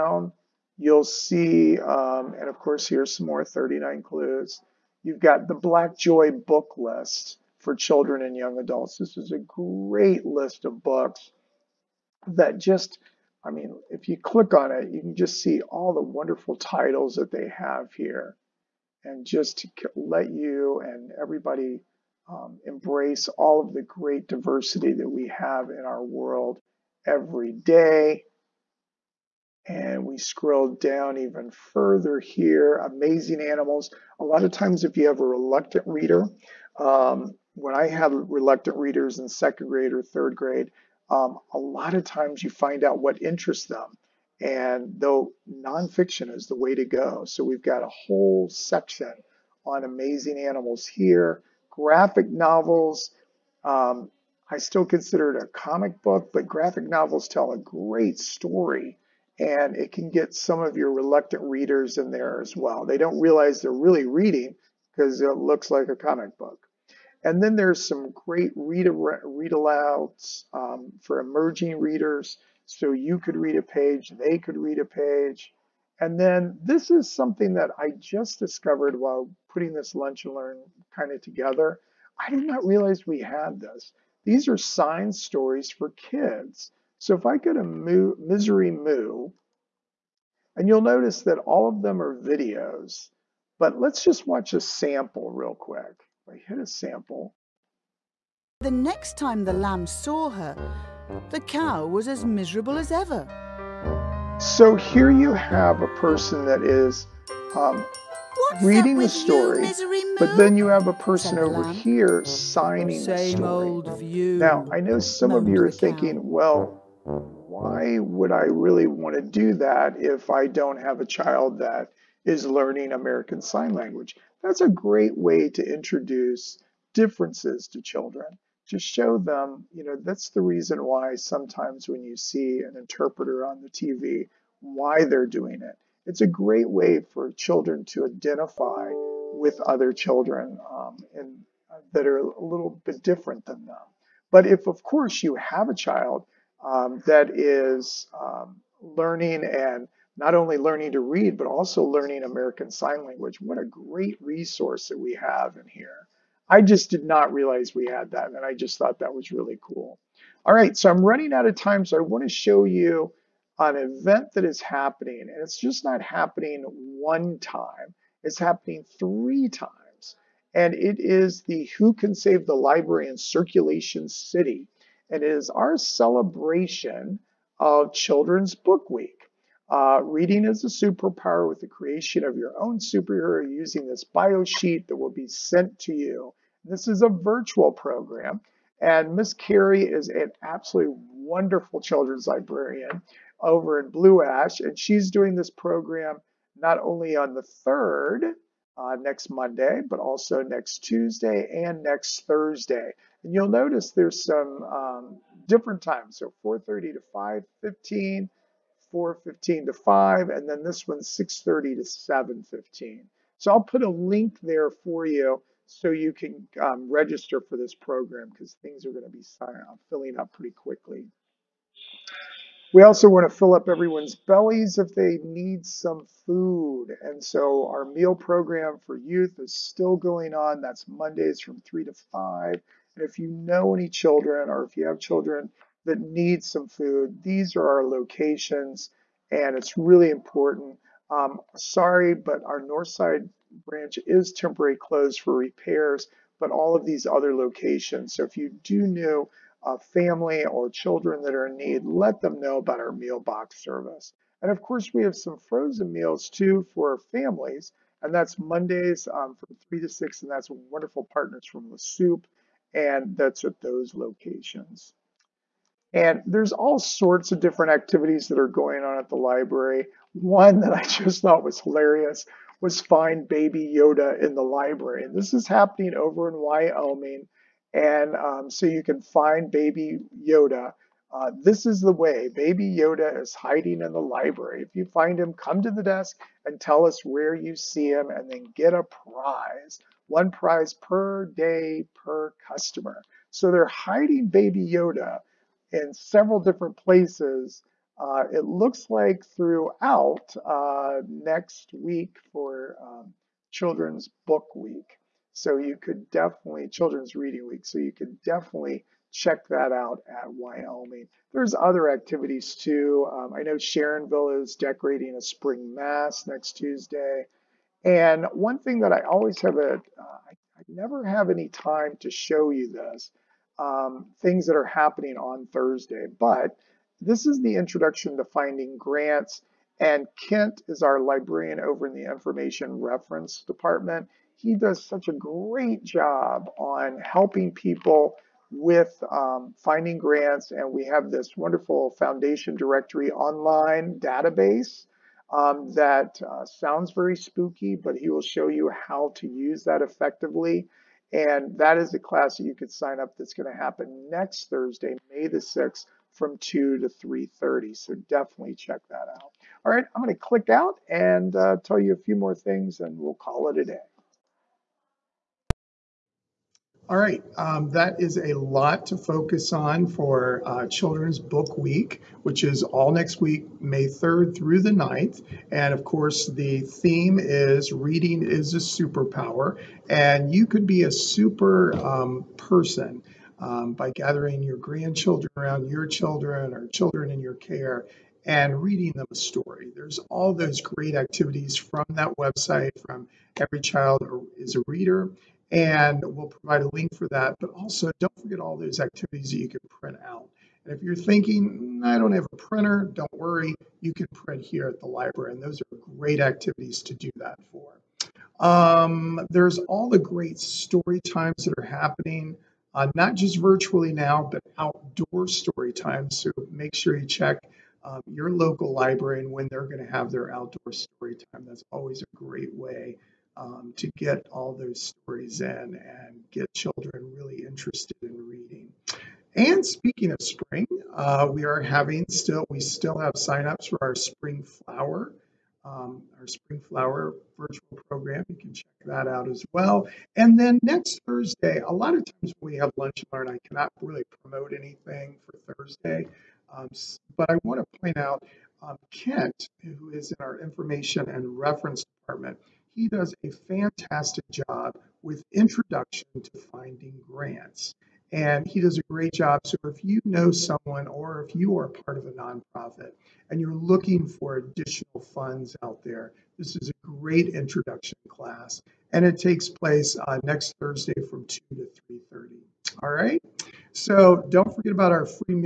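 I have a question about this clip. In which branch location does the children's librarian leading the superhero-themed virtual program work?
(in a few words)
Blue Ash.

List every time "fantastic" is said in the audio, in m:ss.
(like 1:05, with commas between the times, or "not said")
7:33.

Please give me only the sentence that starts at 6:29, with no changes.
There's all those great activities from that website, from Every Child is a Reader, and we'll provide a link for that.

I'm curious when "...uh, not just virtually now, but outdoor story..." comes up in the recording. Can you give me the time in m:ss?
6:52.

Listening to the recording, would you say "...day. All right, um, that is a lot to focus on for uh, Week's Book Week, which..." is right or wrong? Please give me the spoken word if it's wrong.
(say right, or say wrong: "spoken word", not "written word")
wrong: "Children", not "Week".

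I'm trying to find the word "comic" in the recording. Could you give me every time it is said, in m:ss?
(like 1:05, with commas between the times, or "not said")
0:55, 1:05.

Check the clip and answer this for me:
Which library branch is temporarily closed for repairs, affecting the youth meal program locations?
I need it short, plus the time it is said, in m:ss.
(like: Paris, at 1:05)
North side, at 4:02.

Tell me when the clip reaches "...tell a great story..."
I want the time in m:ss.
0:57.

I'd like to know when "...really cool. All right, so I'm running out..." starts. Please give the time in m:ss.
2:39.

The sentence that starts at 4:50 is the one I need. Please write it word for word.
One prize per day per customer.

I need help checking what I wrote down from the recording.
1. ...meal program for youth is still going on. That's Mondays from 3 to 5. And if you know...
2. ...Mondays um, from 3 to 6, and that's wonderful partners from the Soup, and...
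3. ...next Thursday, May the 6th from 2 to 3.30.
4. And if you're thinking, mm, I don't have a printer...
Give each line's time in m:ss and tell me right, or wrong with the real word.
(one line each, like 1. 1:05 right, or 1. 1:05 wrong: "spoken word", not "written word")
1. 3:47 right
2. 4:18 right
3. 5:54 right
4. 6:40 right.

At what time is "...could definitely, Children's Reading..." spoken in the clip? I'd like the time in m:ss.
5:05.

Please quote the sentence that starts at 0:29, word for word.
And we scroll down even further here, amazing animals.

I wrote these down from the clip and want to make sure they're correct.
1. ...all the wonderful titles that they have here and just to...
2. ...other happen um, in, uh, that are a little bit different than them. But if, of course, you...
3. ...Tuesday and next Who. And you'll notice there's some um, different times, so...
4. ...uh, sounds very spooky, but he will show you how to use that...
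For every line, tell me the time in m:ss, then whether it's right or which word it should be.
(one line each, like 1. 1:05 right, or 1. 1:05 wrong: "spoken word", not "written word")
1. 0:15 right
2. 2:19 wrong: "children", not "happen"
3. 3:20 wrong: "Thursday", not "Who"
4. 5:46 right.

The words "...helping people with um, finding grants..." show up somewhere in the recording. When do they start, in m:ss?
5:36.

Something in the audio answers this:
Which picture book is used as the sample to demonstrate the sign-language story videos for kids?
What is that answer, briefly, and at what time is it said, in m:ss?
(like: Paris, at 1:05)
Misery Moo, at 1:27.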